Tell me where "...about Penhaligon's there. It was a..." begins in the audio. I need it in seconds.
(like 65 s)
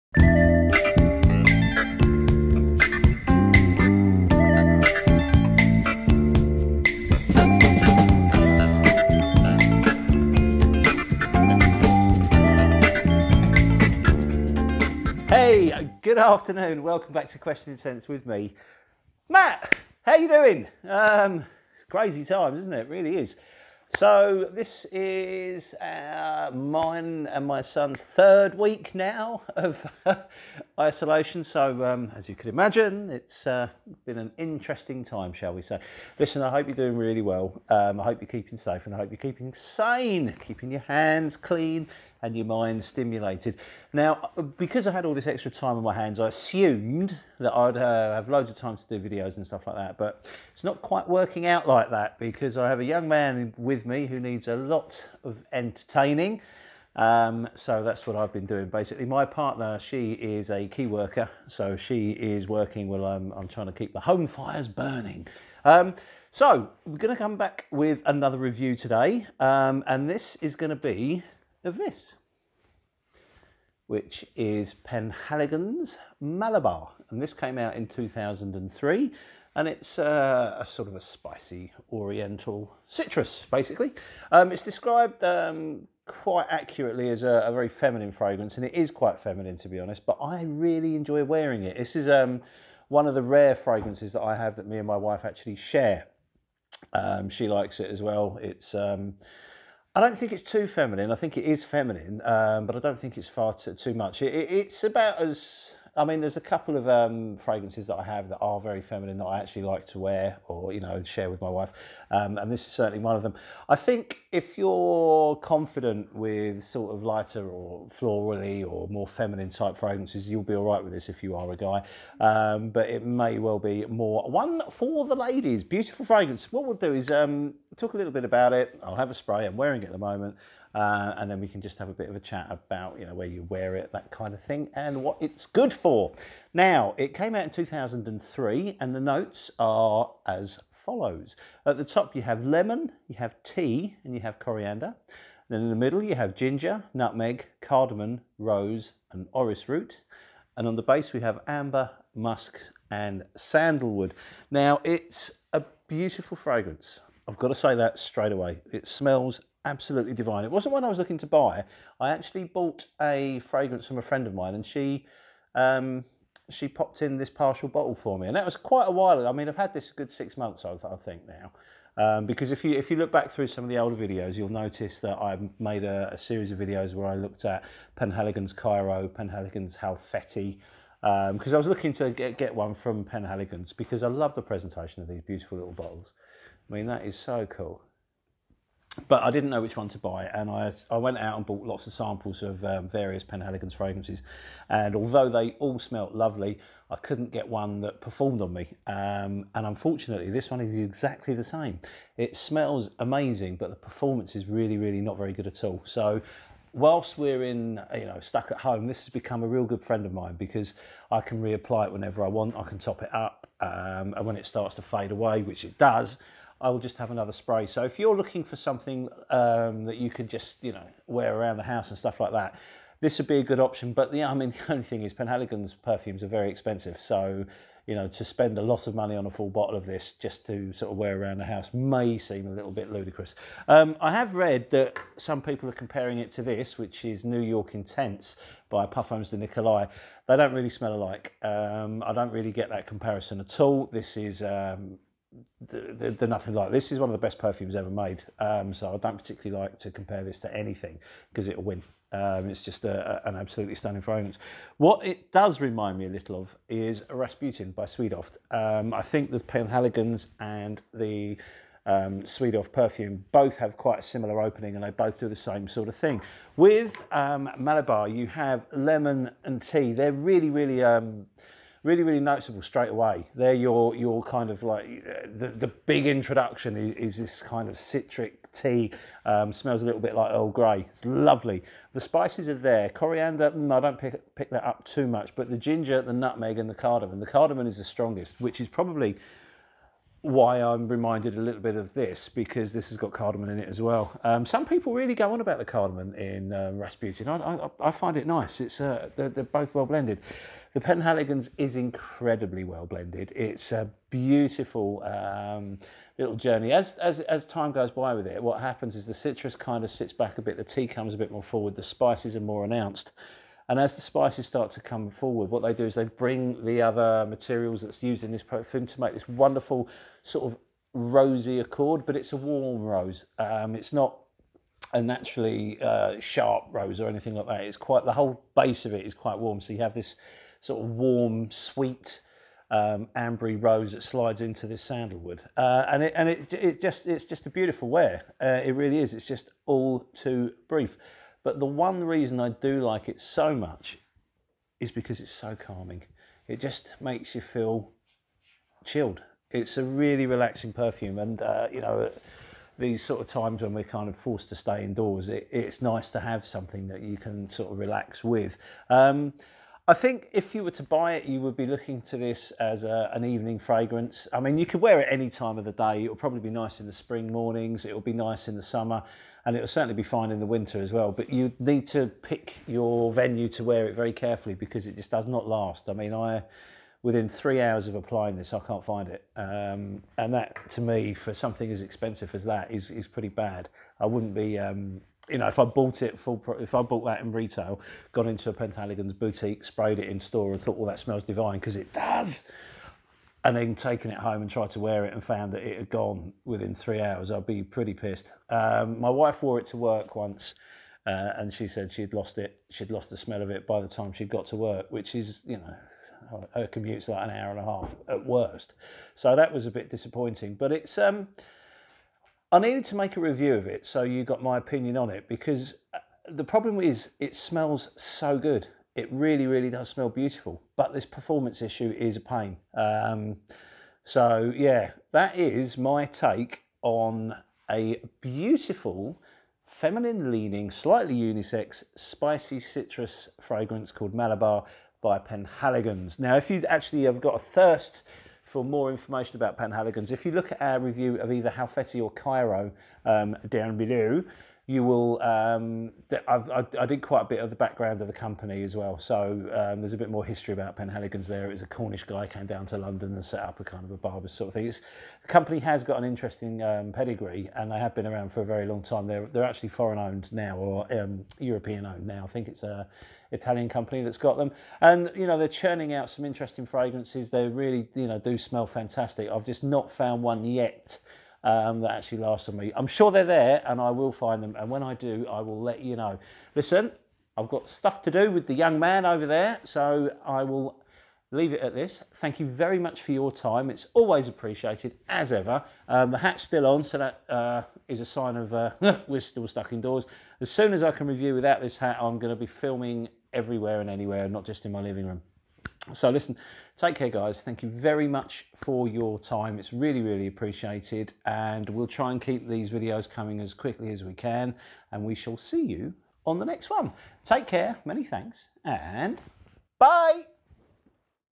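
450 s.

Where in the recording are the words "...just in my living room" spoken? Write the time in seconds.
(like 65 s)
494 s.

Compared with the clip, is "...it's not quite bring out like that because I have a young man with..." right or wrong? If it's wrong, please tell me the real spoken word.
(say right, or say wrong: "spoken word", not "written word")
wrong: "working", not "bring".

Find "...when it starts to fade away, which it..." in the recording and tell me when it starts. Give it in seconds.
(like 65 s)
214 s.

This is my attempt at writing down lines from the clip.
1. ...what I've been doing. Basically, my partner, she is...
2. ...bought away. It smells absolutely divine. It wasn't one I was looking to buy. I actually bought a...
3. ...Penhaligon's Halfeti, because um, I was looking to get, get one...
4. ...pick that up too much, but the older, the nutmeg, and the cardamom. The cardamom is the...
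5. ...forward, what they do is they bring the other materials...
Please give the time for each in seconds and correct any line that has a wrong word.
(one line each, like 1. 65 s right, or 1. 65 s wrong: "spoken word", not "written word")
1. 58 s right
2. 157 s wrong: "straight", not "bought"
3. 179 s right
4. 284 s wrong: "ginger", not "older"
5. 315 s right.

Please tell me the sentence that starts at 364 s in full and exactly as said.
I mean, you could wear it any time of the day.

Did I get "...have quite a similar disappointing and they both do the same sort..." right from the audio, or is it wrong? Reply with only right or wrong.
wrong.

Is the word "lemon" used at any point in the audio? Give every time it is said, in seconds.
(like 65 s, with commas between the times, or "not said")
142 s, 268 s.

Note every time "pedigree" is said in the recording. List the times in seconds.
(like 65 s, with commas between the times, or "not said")
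456 s.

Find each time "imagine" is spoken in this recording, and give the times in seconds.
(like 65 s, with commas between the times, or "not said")
32 s.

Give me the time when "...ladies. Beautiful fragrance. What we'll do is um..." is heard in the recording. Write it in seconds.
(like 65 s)
125 s.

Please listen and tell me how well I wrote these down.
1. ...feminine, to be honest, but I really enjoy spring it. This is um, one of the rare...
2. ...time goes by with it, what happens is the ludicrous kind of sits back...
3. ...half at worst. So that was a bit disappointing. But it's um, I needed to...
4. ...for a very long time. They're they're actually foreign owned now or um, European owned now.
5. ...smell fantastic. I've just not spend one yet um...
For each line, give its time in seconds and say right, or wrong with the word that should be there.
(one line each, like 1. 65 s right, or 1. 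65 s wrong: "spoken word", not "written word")
1. 89 s wrong: "wearing", not "spring"
2. 307 s wrong: "citrus", not "ludicrous"
3. 407 s right
4. 458 s right
5. 468 s wrong: "found", not "spend".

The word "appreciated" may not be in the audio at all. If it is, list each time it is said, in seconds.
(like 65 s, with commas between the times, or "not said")
484 s, 500 s.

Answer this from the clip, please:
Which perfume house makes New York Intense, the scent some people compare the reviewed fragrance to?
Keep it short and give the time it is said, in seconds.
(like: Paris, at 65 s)
Parfums de Nicolai, at 238 s.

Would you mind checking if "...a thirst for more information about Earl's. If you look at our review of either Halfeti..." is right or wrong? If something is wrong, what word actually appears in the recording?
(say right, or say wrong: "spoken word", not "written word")
wrong: "Penhaligon", not "Earl".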